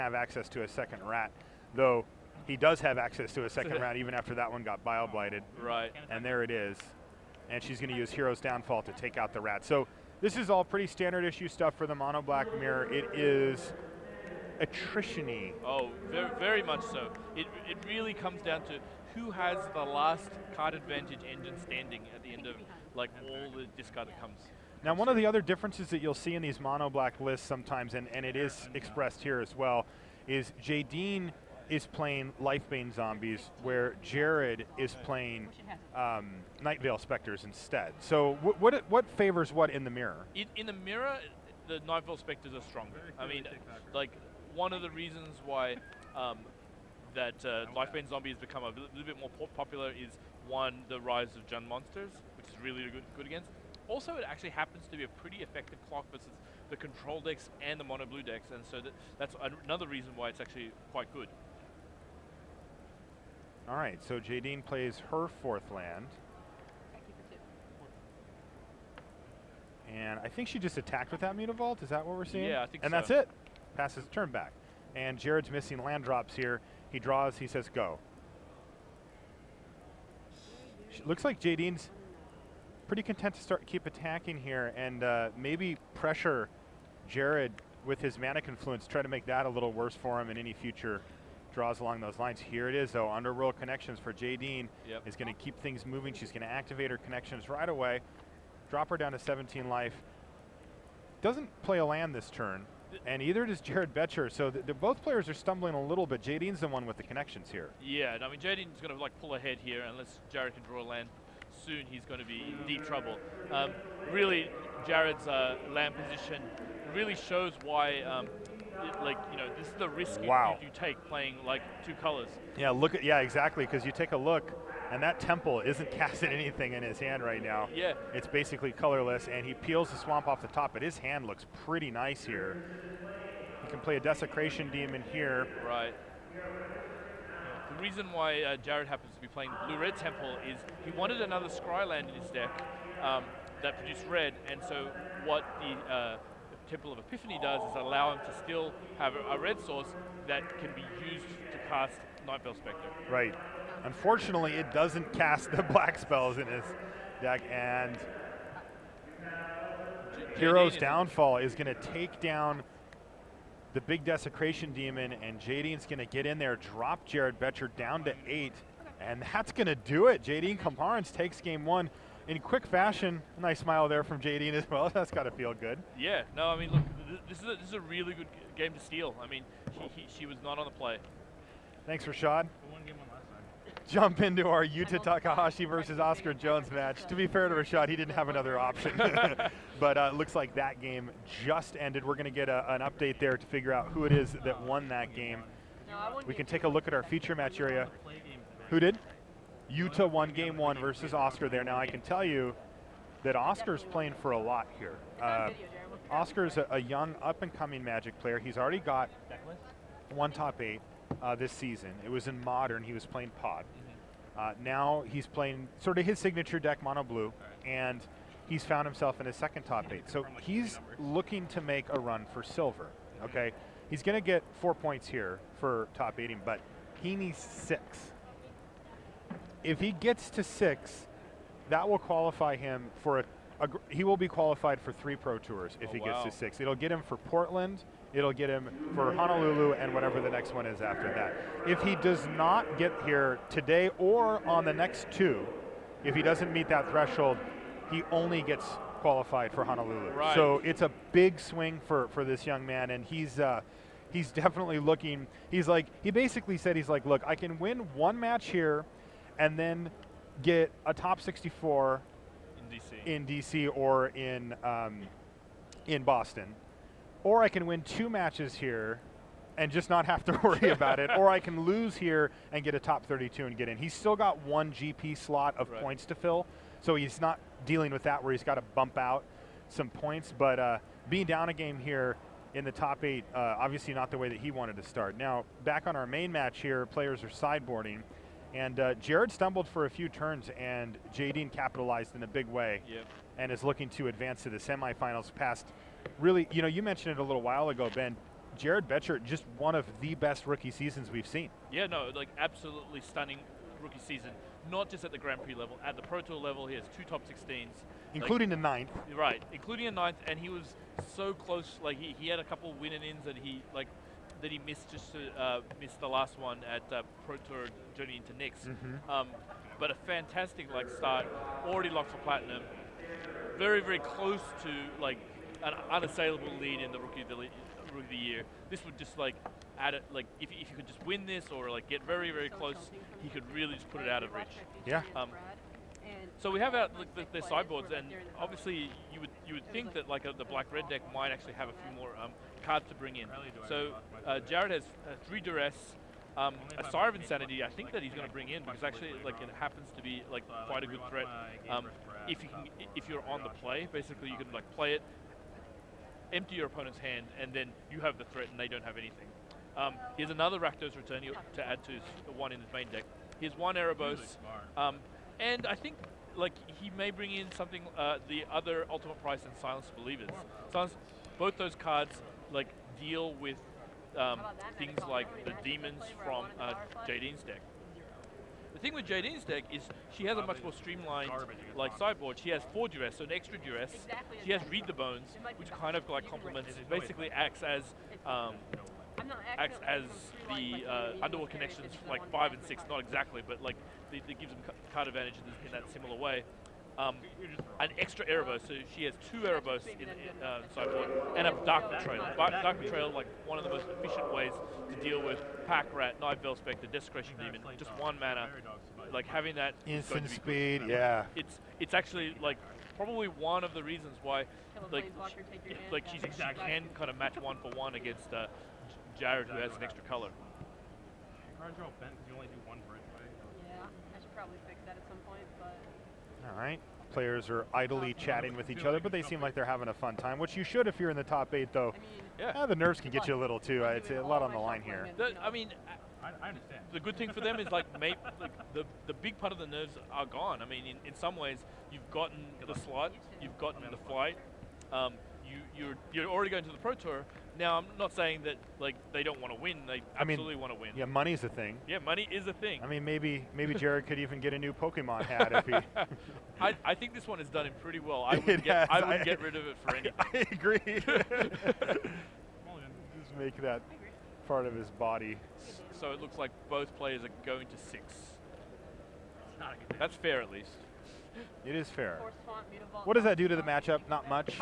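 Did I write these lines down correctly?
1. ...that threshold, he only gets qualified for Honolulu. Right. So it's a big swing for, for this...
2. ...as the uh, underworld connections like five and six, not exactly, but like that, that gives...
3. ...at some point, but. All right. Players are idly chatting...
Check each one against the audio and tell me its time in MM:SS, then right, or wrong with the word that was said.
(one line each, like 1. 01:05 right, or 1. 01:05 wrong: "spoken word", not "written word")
1. 04:06 right
2. 06:29 right
3. 07:04 right.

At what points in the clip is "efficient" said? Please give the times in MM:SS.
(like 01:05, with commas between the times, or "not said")
06:43.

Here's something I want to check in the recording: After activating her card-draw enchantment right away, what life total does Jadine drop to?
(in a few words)
17.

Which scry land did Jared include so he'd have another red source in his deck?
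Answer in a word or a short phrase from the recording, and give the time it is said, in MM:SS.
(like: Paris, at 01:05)
Temple of Epiphany, at 02:26.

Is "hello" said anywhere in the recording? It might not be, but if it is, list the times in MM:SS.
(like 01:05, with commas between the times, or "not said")
not said.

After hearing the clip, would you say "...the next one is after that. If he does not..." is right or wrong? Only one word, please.
right.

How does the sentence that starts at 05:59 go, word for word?
Um, here's another Rakdos Return to add to one in his main deck.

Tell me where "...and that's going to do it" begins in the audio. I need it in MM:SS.
02:48.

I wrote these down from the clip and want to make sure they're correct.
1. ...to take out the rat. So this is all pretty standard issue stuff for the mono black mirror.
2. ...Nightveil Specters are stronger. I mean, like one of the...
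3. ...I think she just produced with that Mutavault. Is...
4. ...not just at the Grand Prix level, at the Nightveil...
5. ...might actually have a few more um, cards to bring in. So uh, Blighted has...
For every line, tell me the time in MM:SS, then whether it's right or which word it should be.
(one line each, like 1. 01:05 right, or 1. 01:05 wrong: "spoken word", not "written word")
1. 00:08 right
2. 00:41 right
3. 01:10 wrong: "attacked", not "produced"
4. 05:04 wrong: "Pro", not "Nightveil"
5. 05:41 wrong: "Jared", not "Blighted".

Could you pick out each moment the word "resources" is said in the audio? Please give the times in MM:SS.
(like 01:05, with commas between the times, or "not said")
not said.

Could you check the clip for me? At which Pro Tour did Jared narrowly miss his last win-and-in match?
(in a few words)
Journey into Nyx.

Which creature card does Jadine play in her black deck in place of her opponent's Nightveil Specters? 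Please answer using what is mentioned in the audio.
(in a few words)
Lifebane Zombie.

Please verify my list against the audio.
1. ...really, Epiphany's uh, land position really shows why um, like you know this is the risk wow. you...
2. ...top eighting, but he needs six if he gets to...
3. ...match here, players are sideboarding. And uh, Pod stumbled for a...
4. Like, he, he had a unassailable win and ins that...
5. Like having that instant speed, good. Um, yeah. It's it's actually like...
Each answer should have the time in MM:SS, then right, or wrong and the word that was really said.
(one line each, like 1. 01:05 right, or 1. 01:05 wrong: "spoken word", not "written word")
1. 01:54 wrong: "Jared", not "Epiphany"
2. 03:45 right
3. 04:46 wrong: "Jared", not "Pod"
4. 05:11 wrong: "couple", not "unassailable"
5. 06:49 right.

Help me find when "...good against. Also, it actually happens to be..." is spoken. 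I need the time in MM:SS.
00:53.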